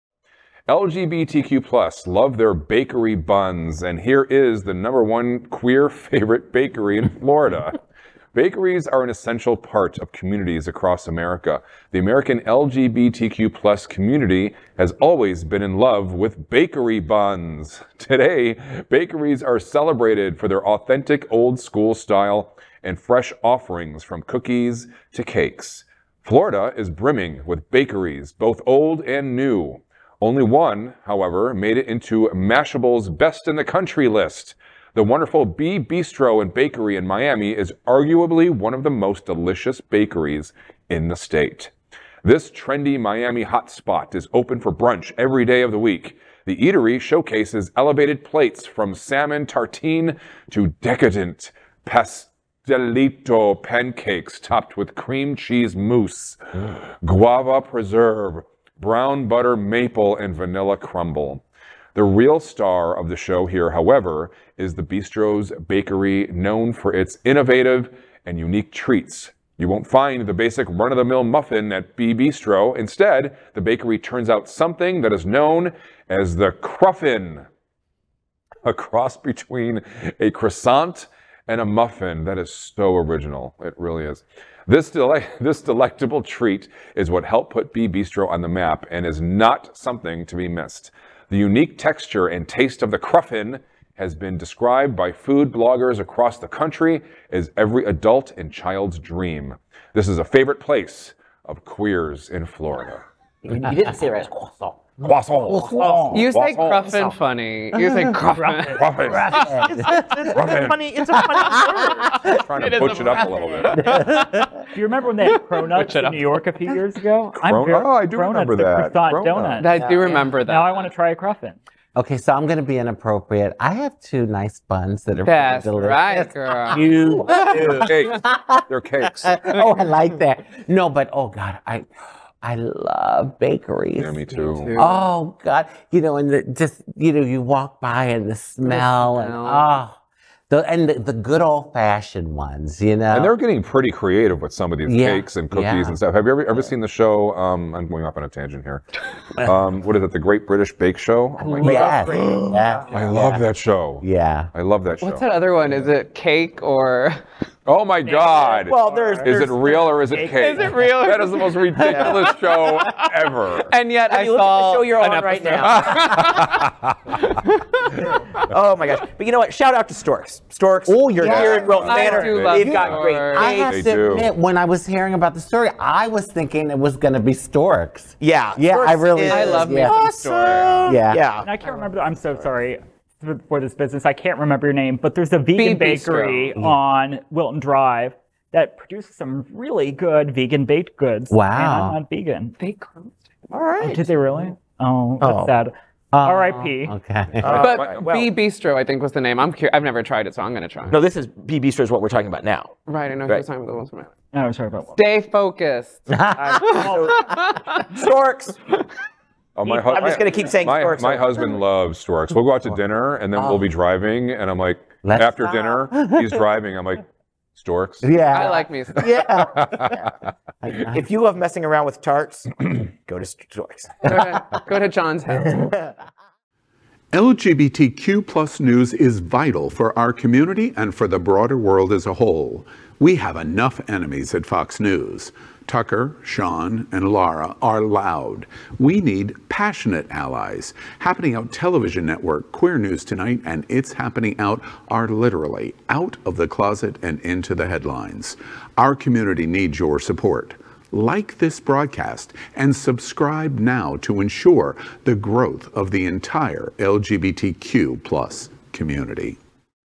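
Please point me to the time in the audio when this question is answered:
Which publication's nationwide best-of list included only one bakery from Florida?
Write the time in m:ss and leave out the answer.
0:32.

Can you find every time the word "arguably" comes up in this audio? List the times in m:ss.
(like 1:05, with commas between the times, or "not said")
0:37.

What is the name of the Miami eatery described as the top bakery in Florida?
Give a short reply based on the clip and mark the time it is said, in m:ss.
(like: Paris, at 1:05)
B Bistro and Bakery, at 0:35.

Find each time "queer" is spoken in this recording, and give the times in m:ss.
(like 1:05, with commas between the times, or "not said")
0:05, 1:41, 4:02.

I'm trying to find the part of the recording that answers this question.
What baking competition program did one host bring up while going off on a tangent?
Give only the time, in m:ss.
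2:30.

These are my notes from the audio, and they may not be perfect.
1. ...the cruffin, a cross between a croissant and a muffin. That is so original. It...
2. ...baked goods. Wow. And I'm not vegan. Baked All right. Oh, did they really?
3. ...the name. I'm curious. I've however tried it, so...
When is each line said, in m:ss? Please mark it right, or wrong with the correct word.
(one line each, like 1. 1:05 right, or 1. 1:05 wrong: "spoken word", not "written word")
1. 1:16 right
2. 3:10 right
3. 3:19 wrong: "never", not "however".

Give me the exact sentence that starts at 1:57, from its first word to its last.
Cron- very, oh, I do cronuts, remember that.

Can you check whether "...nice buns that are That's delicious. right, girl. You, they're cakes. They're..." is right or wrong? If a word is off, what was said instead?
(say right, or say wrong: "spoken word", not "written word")
right.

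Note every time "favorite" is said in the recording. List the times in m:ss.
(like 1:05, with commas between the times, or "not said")
0:05, 1:40.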